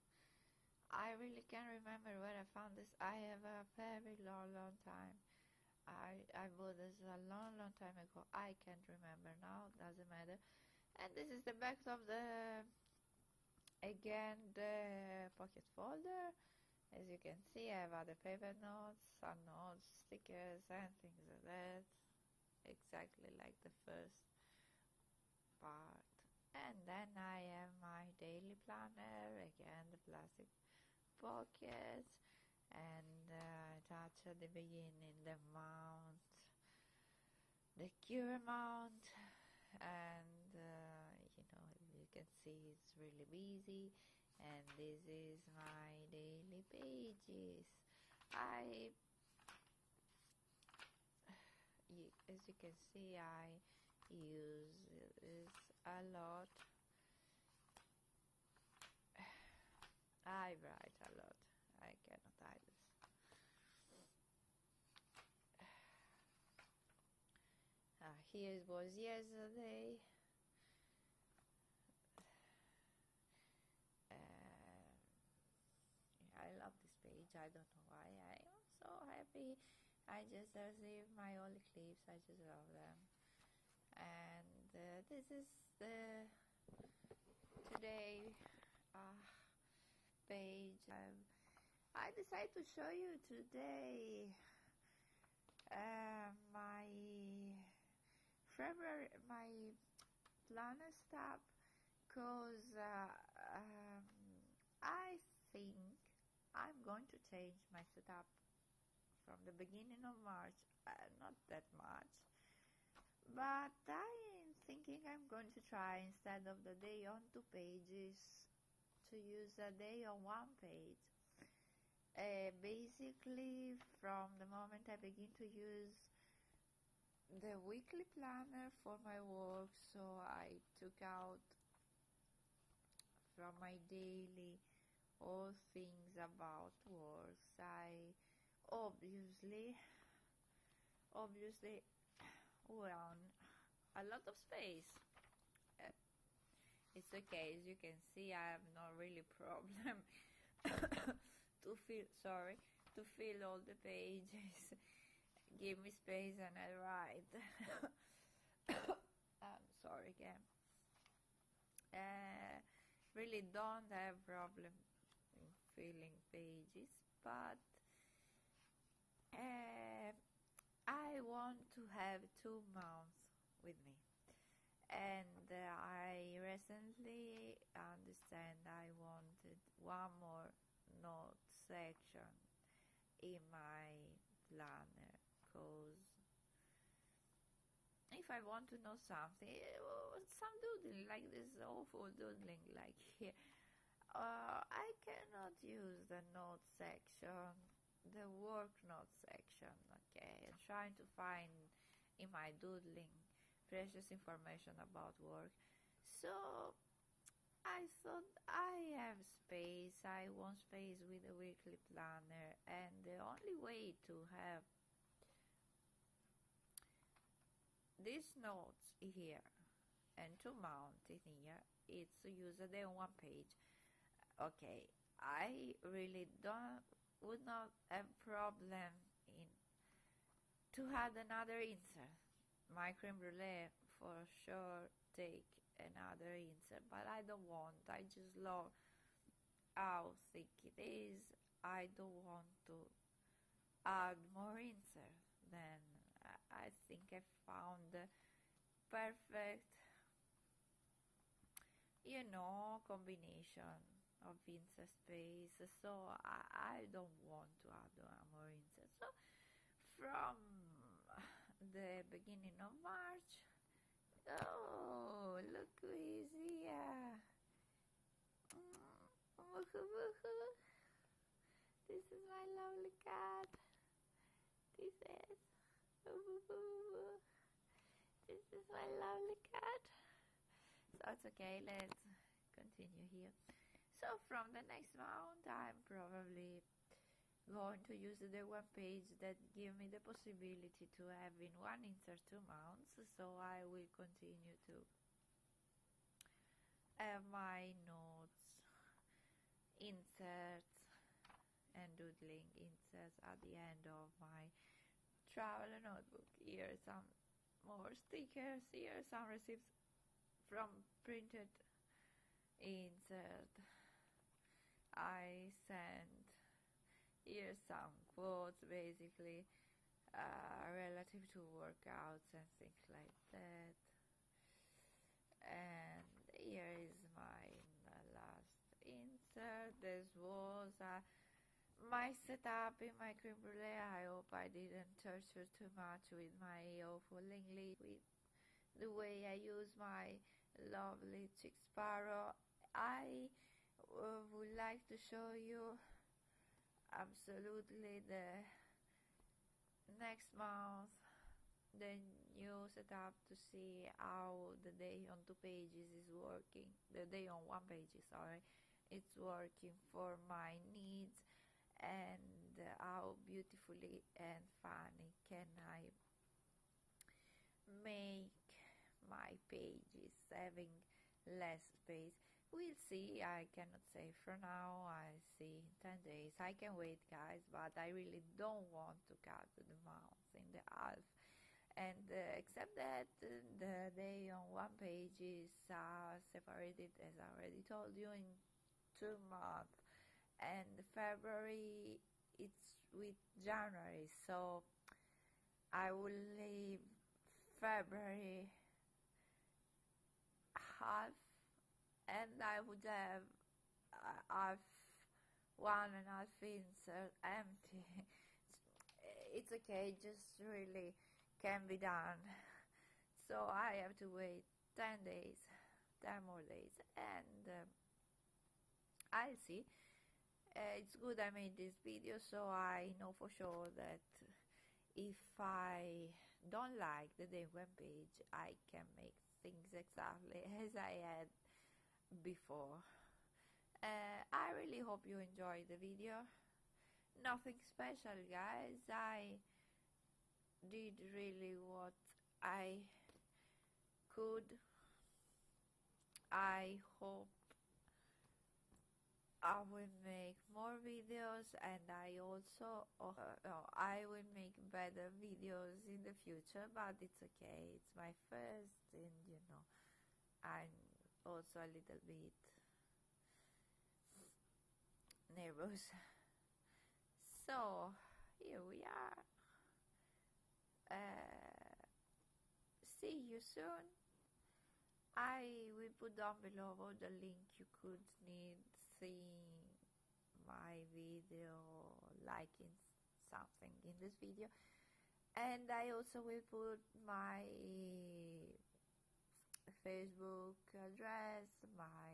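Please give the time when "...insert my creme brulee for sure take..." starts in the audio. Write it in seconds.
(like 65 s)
231 s.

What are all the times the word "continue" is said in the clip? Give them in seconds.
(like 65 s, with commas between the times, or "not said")
282 s, 293 s.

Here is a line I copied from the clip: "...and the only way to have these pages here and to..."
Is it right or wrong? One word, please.
wrong.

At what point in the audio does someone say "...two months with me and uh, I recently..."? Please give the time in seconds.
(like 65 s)
172 s.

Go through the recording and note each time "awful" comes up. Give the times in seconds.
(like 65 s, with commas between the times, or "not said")
191 s, 336 s.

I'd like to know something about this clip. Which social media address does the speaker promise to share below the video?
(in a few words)
Facebook.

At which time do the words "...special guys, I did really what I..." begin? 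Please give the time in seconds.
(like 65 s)
437 s.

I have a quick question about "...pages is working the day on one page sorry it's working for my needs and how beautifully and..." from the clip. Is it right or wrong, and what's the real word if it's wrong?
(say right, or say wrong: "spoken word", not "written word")
right.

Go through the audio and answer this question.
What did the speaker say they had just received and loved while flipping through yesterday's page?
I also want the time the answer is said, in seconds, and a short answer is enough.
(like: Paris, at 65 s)
old clips, at 81 s.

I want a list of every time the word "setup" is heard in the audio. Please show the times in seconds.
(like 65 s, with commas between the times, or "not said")
107 s, 332 s.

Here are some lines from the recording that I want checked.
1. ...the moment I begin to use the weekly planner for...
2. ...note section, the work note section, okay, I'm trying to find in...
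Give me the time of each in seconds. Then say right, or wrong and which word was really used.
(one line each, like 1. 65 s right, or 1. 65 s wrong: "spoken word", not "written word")
1. 124 s right
2. 196 s right.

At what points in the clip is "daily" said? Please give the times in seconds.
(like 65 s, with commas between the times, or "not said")
28 s, 46 s, 133 s.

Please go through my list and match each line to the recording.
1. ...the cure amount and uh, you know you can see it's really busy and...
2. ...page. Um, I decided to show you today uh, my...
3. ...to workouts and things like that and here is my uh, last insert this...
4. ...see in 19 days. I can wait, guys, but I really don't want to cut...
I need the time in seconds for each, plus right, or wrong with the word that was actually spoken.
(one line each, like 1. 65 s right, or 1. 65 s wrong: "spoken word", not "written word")
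1. 37 s right
2. 90 s right
3. 321 s right
4. 375 s wrong: "10", not "19".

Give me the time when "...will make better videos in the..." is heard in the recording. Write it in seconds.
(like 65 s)
454 s.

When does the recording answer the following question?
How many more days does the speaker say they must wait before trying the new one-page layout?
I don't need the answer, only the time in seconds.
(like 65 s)
415 s.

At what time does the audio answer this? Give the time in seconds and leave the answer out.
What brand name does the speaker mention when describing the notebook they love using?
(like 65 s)
341 s.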